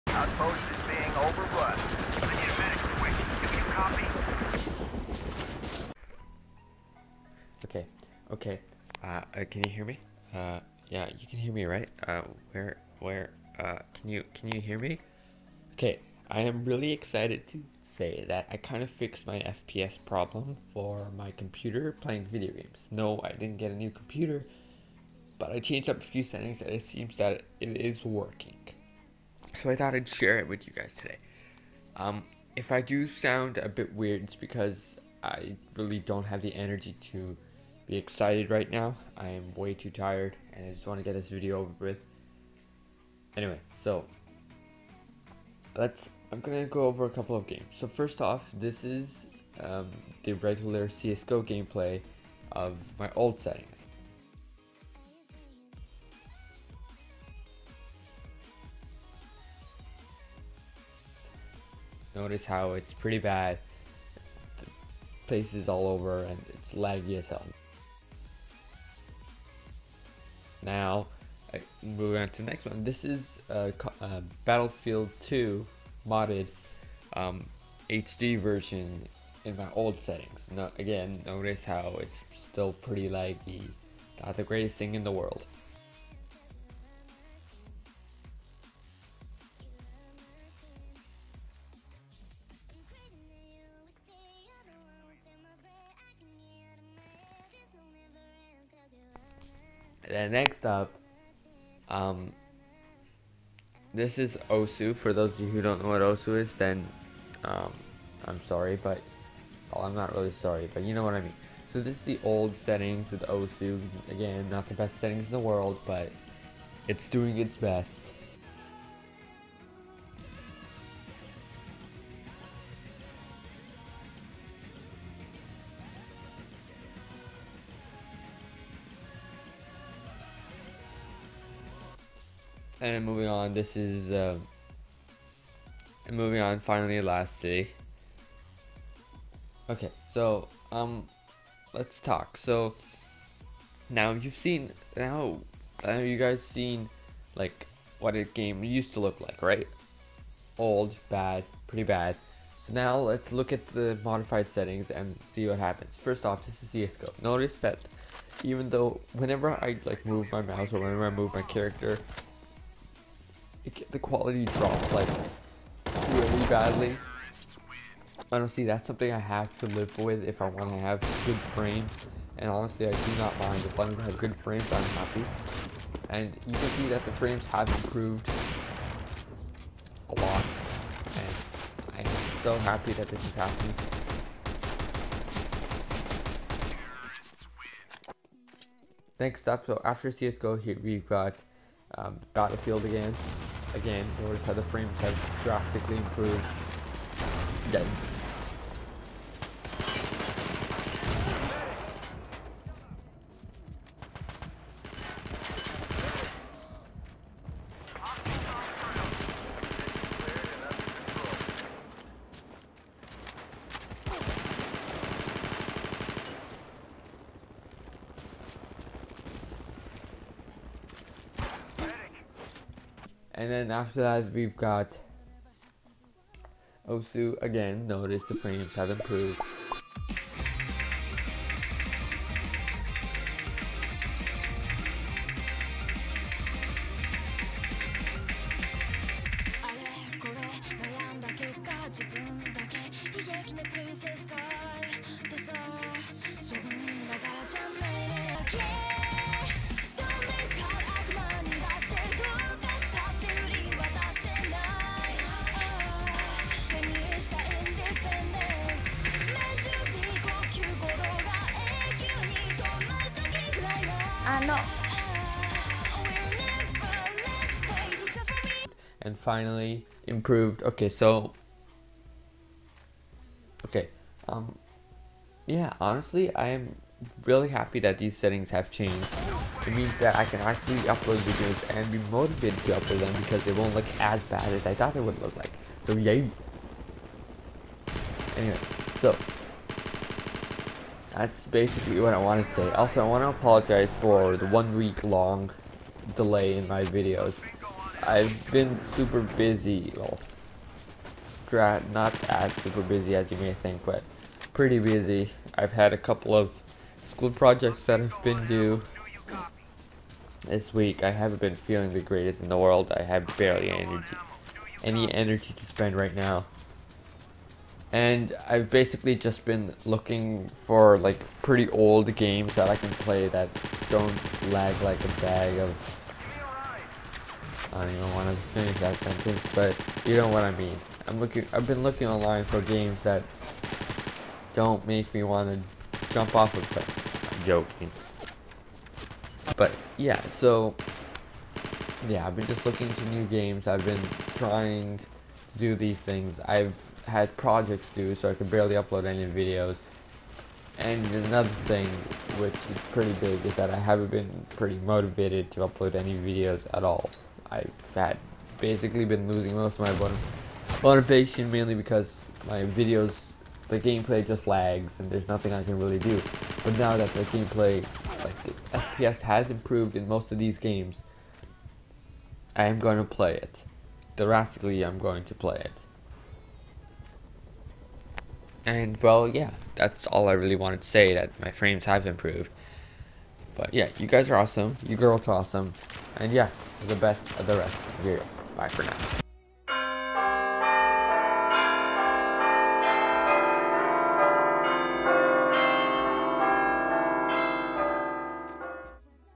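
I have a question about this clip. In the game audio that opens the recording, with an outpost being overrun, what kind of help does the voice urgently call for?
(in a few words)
a medic.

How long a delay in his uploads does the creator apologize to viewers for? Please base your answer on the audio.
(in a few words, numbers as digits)
one week.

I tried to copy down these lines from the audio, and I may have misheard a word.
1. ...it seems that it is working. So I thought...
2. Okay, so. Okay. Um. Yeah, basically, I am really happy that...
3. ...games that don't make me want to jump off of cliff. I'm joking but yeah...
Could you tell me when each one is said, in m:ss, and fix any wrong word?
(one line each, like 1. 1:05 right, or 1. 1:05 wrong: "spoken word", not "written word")
1. 0:26 right
2. 4:30 wrong: "honestly", not "basically"
3. 5:32 right.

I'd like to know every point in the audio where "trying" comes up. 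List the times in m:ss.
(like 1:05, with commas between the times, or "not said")
5:44.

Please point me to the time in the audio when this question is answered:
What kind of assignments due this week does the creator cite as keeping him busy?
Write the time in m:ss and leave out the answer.
5:07.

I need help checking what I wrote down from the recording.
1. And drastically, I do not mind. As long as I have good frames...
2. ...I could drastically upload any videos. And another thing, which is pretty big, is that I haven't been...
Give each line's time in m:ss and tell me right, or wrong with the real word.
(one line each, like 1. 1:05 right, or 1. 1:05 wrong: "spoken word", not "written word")
1. 2:52 wrong: "honestly", not "drastically"
2. 5:48 wrong: "barely", not "drastically".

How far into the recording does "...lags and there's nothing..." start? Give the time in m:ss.
6:04.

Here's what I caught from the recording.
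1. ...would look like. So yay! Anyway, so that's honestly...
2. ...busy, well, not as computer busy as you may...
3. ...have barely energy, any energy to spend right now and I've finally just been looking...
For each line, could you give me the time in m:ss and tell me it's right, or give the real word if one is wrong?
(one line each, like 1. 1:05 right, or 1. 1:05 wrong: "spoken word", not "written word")
1. 4:45 wrong: "basically", not "honestly"
2. 4:59 wrong: "super", not "computer"
3. 5:13 wrong: "basically", not "finally".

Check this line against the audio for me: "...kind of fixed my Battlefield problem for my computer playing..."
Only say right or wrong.
wrong.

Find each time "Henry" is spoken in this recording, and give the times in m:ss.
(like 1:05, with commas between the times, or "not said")
not said.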